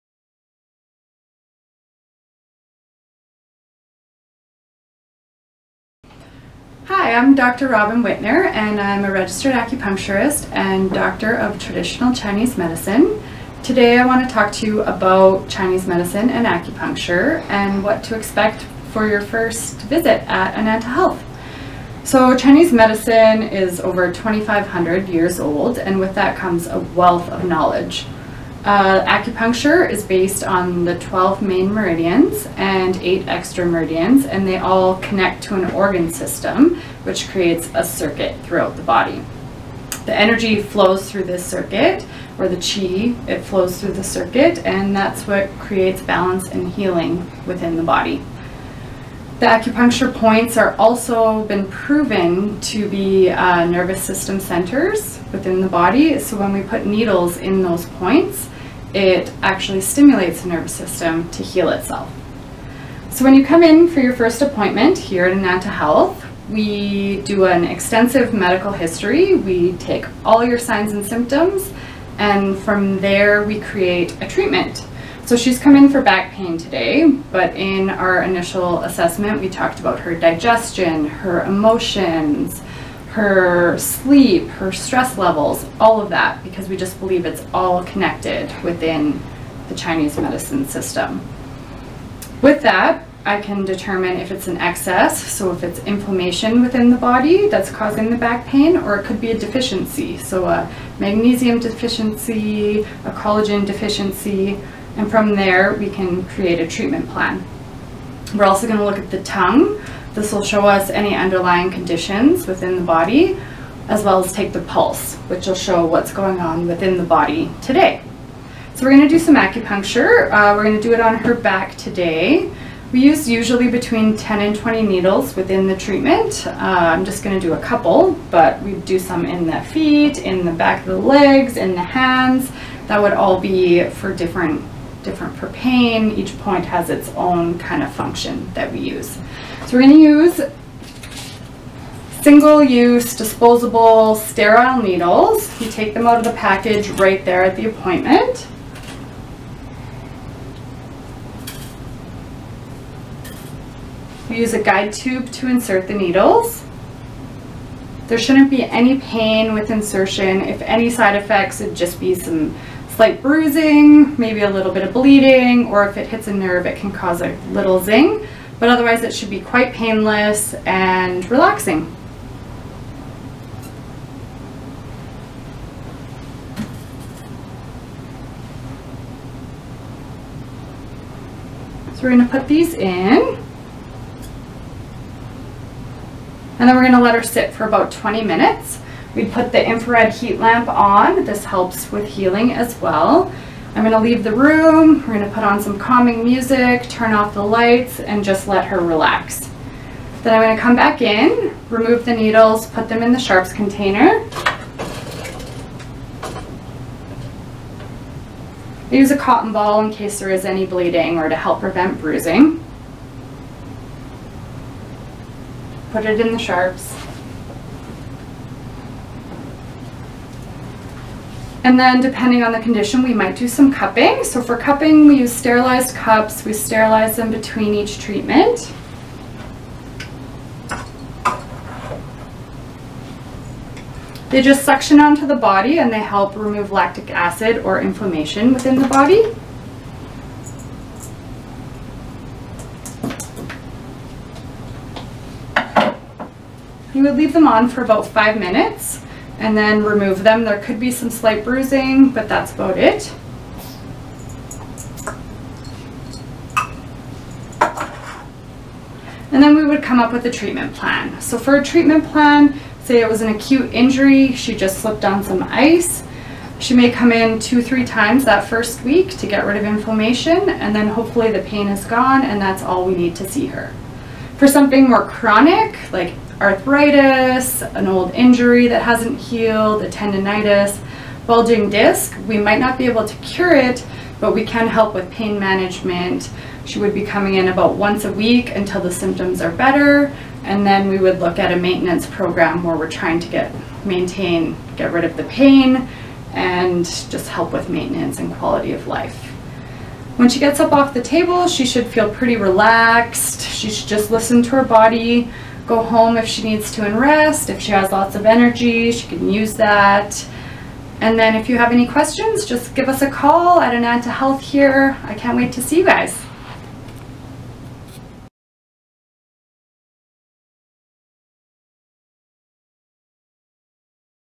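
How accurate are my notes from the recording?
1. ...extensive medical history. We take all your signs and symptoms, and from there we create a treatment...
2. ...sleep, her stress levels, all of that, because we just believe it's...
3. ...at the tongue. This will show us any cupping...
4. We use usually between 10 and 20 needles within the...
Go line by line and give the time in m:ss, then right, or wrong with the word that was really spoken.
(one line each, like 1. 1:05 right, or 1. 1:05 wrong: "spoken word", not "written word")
1. 1:07 right
2. 1:23 right
3. 1:48 wrong: "underlying", not "cupping"
4. 2:02 right.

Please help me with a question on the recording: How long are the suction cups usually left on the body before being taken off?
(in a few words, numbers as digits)
5 minutes.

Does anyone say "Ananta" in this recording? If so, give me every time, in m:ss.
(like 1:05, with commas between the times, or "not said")
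0:20, 1:05, 5:13.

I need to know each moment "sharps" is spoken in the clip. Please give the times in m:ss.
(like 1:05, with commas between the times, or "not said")
3:23, 3:36.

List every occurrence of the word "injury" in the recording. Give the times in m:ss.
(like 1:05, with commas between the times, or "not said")
4:23, 4:38.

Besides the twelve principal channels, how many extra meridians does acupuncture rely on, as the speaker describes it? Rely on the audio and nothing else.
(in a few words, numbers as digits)
8.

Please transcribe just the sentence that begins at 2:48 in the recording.
But otherwise, it should be quite painless and relaxing.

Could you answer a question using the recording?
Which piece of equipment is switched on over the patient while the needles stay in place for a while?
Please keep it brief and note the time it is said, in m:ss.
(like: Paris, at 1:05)
infrared heat lamp, at 3:09.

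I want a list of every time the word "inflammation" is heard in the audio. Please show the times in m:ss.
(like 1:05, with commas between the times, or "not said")
1:35, 3:57, 4:29.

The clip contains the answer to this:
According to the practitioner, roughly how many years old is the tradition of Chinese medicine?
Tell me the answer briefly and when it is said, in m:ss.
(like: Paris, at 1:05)
2,500, at 0:24.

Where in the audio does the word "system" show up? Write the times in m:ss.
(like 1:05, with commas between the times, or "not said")
0:36, 0:54, 1:00, 1:30.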